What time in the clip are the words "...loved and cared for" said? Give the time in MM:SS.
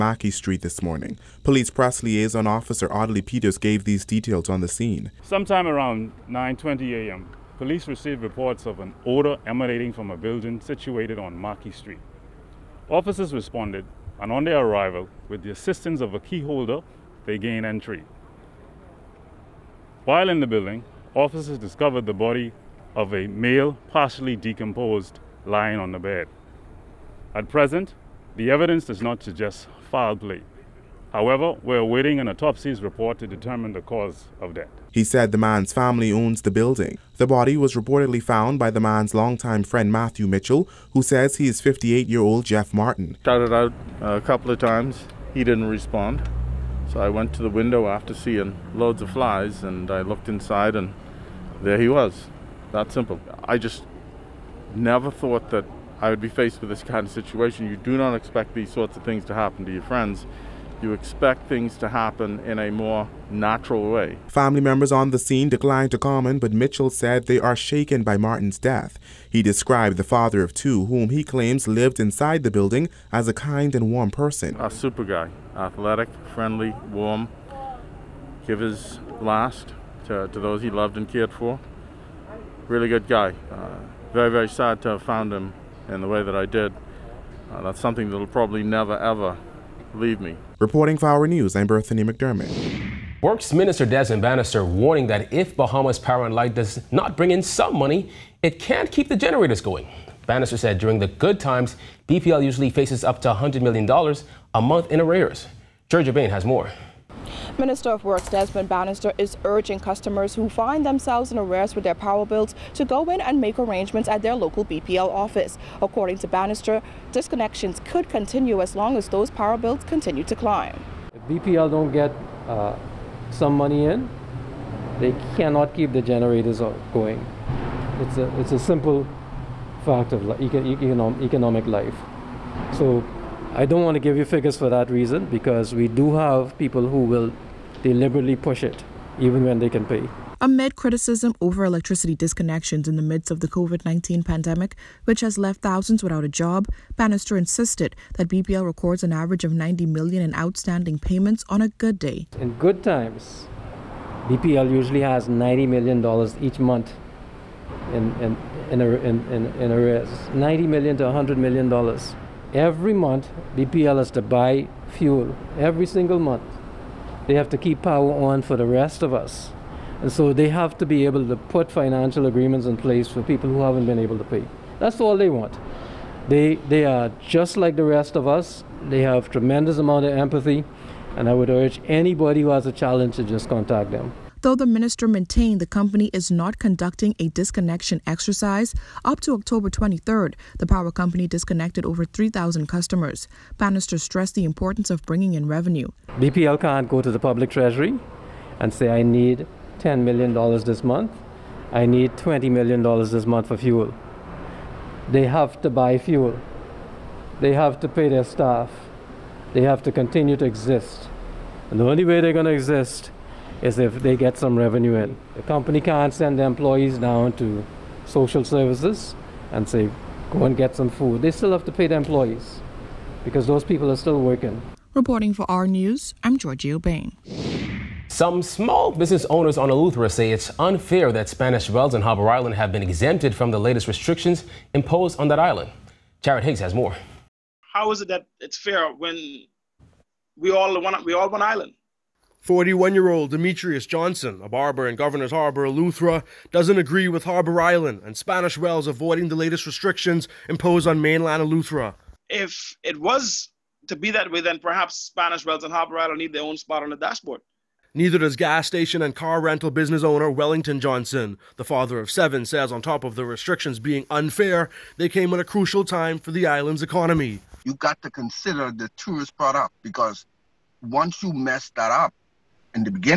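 01:20.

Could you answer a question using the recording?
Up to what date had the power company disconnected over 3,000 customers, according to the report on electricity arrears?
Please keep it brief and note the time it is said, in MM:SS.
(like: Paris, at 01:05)
October 23rd, at 03:09.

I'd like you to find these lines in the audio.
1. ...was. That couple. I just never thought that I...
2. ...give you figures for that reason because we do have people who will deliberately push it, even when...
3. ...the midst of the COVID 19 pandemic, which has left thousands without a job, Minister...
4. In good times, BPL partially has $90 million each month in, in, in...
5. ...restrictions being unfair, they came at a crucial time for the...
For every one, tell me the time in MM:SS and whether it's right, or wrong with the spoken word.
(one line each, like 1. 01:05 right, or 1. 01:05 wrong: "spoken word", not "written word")
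1. 00:51 wrong: "simple", not "couple"
2. 02:13 right
3. 02:22 wrong: "Bannister", not "Minister"
4. 02:32 wrong: "usually", not "partially"
5. 04:23 right.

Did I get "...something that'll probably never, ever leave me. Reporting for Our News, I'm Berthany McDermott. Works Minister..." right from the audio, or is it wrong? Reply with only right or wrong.
right.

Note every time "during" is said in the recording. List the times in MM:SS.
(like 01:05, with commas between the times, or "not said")
01:40.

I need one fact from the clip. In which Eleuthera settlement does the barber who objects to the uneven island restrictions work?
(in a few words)
Governor's Harbor.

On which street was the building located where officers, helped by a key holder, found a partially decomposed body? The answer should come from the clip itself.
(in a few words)
Mackey Street.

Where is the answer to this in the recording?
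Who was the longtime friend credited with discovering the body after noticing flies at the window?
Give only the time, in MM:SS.
00:39.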